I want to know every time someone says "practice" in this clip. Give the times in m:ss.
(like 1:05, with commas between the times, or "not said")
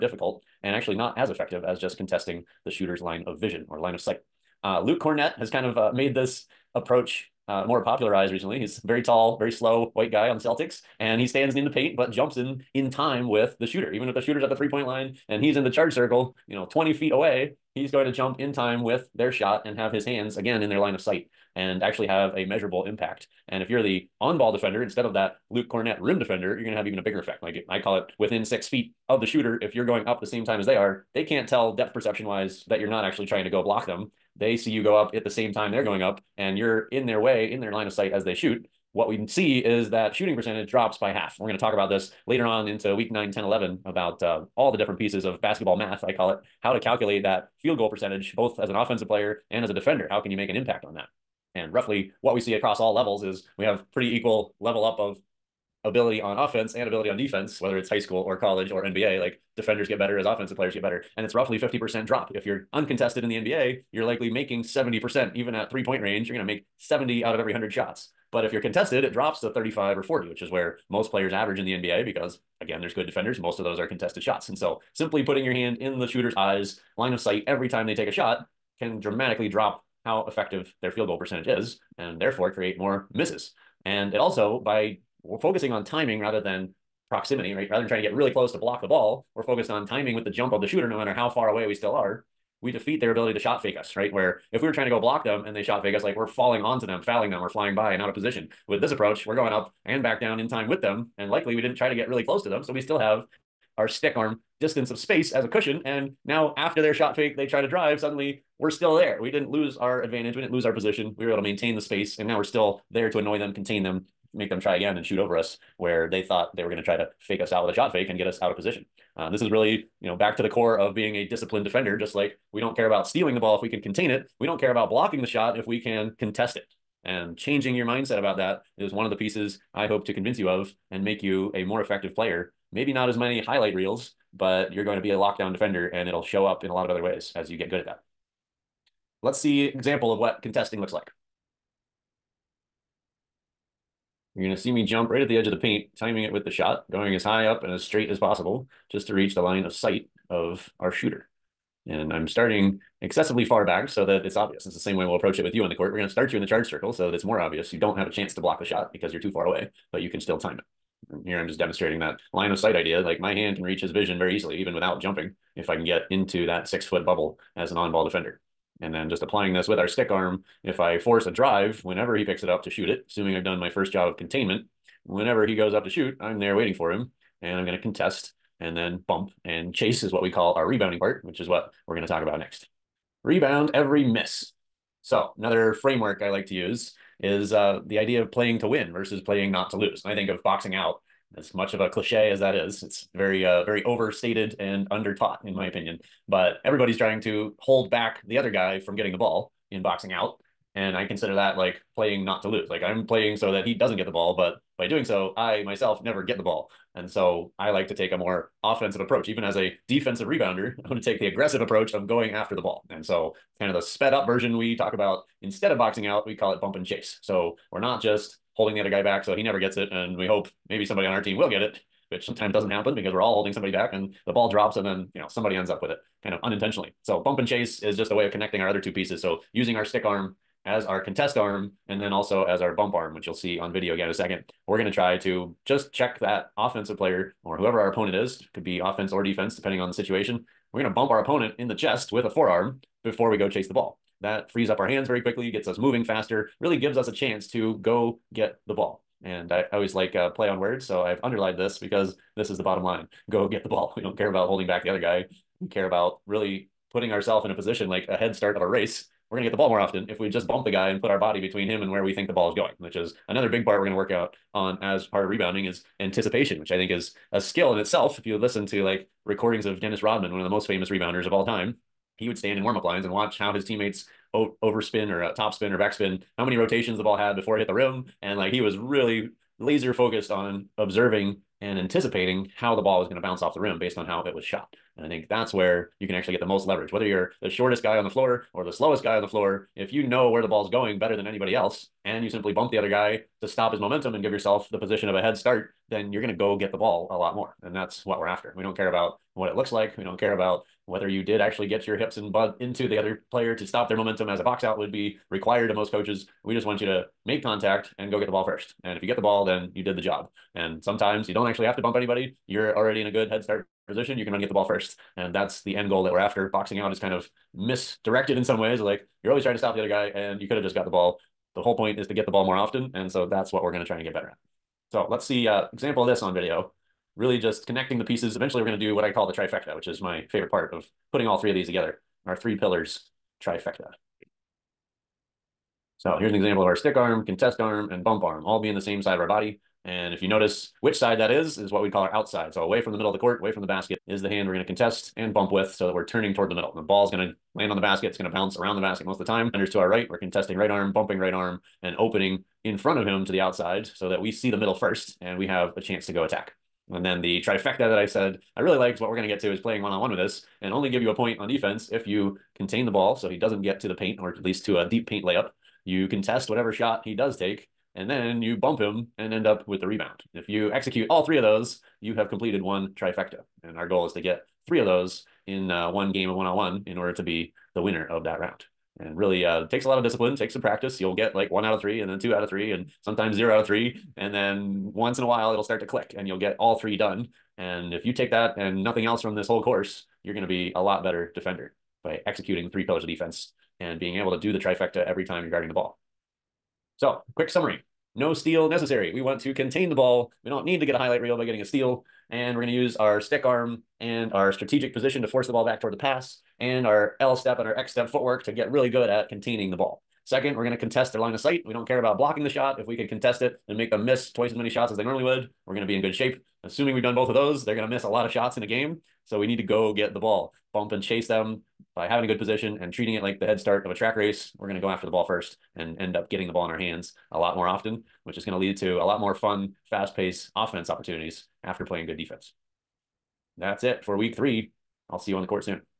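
6:20.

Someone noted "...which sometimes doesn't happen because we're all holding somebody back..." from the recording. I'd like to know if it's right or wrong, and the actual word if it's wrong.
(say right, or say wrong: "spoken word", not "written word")
right.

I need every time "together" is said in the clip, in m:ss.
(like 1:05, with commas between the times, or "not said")
5:31.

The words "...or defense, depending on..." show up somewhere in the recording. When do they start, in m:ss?
3:59.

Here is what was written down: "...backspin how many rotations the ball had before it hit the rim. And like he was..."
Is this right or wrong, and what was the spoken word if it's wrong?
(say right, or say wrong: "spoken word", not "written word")
right.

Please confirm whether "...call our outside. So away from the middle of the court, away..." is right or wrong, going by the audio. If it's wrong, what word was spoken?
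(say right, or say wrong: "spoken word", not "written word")
right.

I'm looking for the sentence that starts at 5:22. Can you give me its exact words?
And so that's what we're going to try and get better at.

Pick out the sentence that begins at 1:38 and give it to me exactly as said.
With this approach, we're going up and back down in time with them.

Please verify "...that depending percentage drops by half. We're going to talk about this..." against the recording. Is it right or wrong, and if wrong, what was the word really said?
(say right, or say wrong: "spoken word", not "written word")
wrong: "shooting", not "depending".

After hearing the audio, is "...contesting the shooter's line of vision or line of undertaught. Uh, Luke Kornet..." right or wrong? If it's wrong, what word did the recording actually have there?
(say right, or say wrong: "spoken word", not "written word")
wrong: "sight", not "undertaught".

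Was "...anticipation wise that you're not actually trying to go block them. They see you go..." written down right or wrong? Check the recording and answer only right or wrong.
wrong.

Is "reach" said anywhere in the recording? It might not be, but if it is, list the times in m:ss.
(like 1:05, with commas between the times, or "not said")
2:29, 2:43.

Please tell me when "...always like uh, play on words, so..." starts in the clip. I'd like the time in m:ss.
4:09.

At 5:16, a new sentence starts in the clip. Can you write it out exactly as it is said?
Boxing out is kind of misdirected in some ways.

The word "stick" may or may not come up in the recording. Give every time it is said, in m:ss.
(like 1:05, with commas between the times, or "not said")
1:43, 2:49, 3:49, 5:36, 6:43.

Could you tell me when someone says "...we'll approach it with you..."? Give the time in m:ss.
2:35.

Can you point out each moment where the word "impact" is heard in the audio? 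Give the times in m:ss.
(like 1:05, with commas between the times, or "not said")
0:22, 0:50.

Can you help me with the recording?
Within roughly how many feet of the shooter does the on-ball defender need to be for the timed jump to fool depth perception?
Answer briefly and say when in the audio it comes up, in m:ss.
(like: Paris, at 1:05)
6, at 0:28.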